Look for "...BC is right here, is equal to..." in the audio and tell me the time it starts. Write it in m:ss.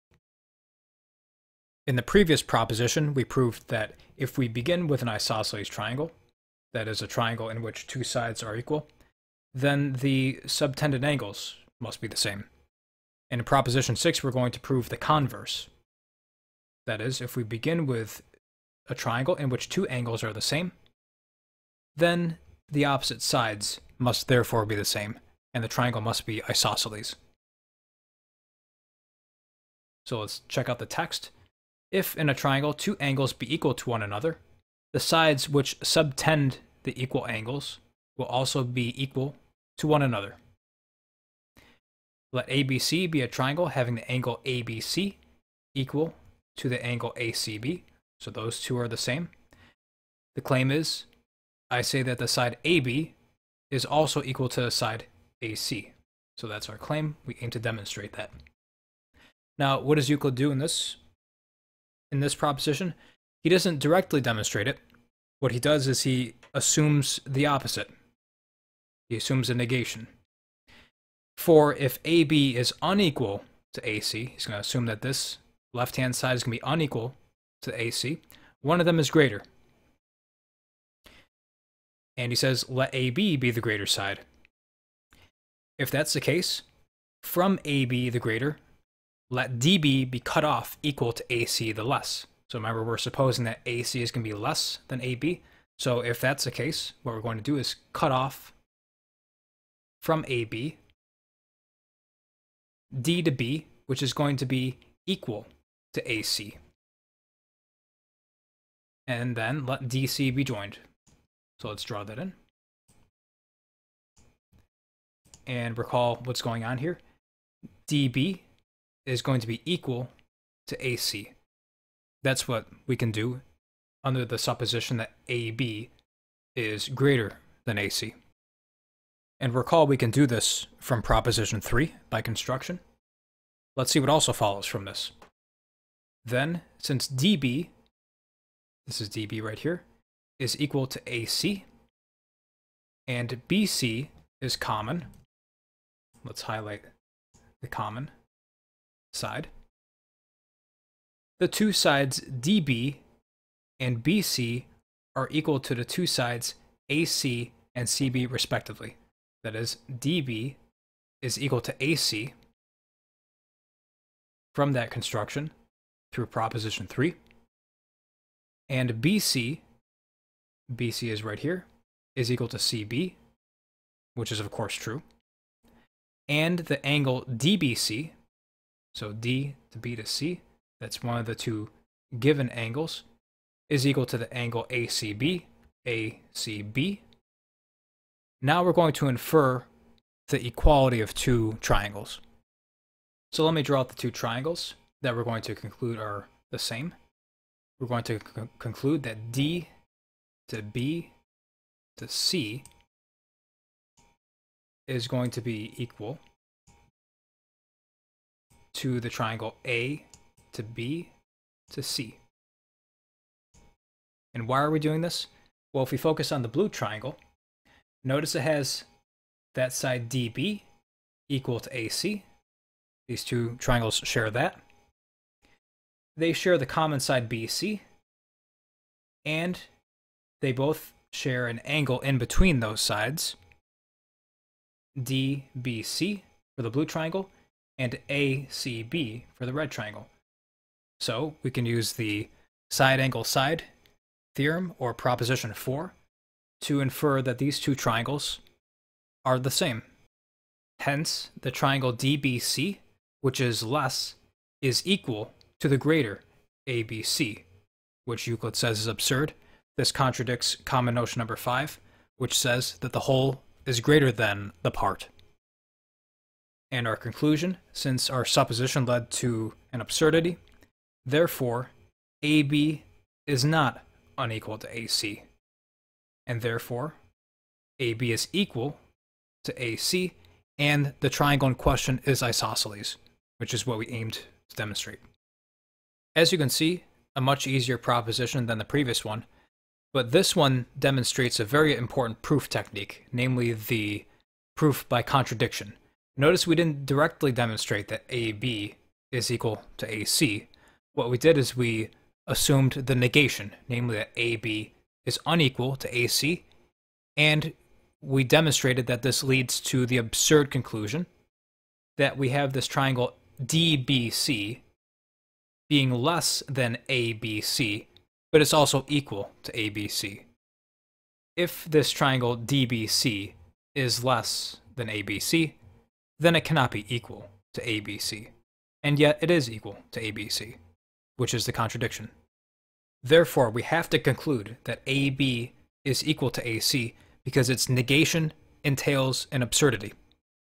2:50.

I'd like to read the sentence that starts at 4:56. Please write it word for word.
Notice we didn't directly demonstrate that AB is equal to AC.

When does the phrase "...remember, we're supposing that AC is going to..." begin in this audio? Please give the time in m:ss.
1:32.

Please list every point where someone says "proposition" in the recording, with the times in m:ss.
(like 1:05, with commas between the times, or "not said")
0:02, 0:13, 1:02, 2:11, 2:46, 4:04, 4:47.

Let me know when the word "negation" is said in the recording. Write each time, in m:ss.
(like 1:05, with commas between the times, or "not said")
1:09, 5:02, 5:37.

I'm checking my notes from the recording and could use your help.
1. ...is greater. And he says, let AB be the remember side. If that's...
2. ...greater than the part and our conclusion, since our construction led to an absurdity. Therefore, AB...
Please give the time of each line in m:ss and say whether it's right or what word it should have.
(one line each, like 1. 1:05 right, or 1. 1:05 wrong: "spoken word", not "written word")
1. 1:18 wrong: "greater", not "remember"
2. 4:23 wrong: "supposition", not "construction".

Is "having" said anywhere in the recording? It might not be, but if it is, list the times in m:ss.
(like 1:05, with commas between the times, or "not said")
0:43.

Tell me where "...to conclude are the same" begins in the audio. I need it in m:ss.
3:15.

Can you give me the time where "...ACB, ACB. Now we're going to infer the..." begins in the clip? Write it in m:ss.
3:04.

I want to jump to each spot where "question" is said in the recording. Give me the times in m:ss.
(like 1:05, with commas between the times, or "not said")
4:41.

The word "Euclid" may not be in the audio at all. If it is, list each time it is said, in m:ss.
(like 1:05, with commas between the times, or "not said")
1:00, 4:18.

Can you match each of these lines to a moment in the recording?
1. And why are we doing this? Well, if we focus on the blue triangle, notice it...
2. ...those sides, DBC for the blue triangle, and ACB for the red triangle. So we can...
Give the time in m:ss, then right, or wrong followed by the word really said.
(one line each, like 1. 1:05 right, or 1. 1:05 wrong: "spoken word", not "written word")
1. 3:34 right
2. 3:52 right.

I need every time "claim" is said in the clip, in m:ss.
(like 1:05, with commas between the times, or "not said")
0:50, 0:56.